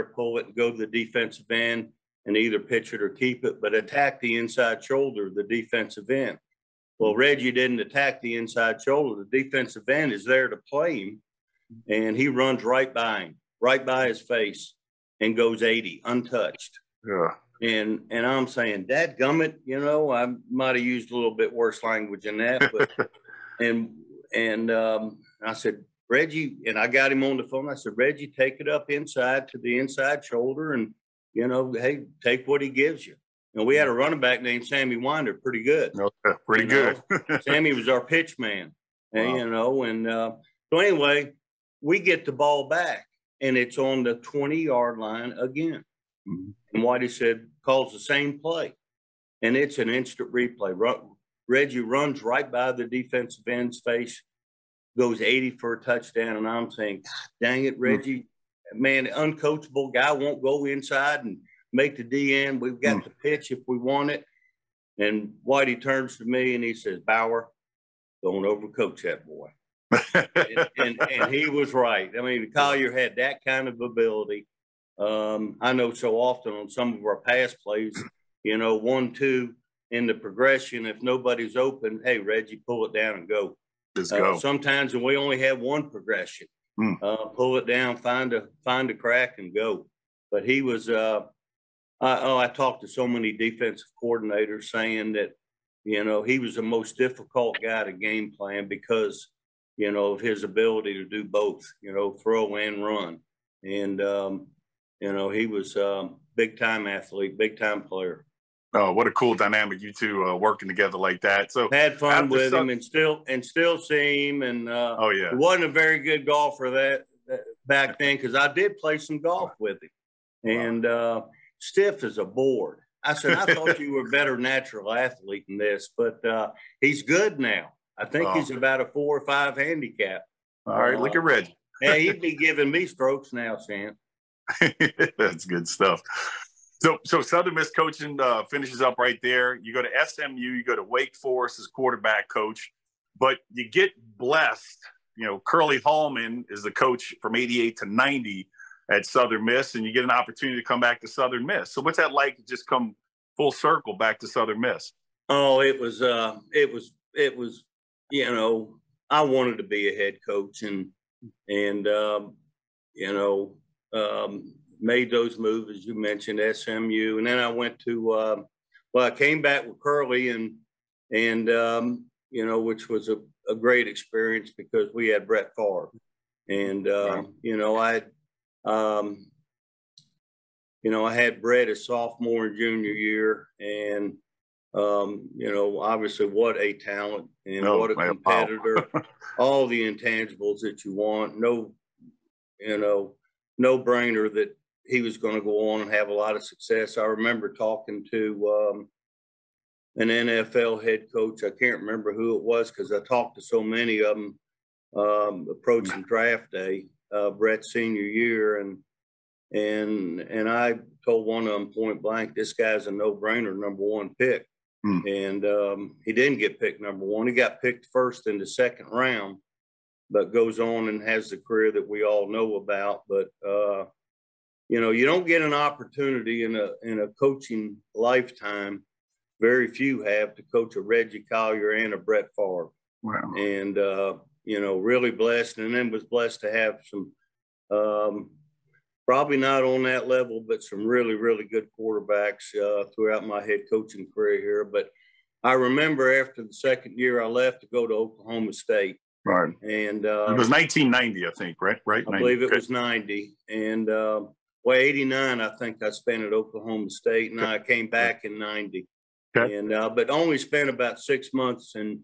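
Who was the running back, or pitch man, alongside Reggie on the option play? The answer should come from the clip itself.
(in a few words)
Sammy Winder.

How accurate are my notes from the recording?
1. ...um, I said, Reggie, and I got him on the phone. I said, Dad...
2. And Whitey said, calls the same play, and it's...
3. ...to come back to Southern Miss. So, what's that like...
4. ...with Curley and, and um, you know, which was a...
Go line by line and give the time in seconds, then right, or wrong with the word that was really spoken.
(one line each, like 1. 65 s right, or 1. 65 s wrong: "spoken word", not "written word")
1. 24 s wrong: "Reggie", not "Dad"
2. 46 s right
3. 150 s right
4. 169 s right.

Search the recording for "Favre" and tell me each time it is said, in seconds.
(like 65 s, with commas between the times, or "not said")
175 s, 232 s.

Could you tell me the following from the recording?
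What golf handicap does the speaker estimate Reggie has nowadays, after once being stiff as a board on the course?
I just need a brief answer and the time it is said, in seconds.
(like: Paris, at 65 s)
4 or 5, at 128 s.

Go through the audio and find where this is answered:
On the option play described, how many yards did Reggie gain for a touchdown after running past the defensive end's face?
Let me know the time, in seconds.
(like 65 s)
15 s.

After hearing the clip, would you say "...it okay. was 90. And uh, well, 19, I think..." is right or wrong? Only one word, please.
wrong.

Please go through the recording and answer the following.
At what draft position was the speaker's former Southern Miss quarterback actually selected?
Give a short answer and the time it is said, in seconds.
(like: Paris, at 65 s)
First in the second round, at 217 s.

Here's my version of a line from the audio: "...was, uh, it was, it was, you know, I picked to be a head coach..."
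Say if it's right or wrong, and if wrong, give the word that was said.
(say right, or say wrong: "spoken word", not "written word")
wrong: "wanted", not "picked".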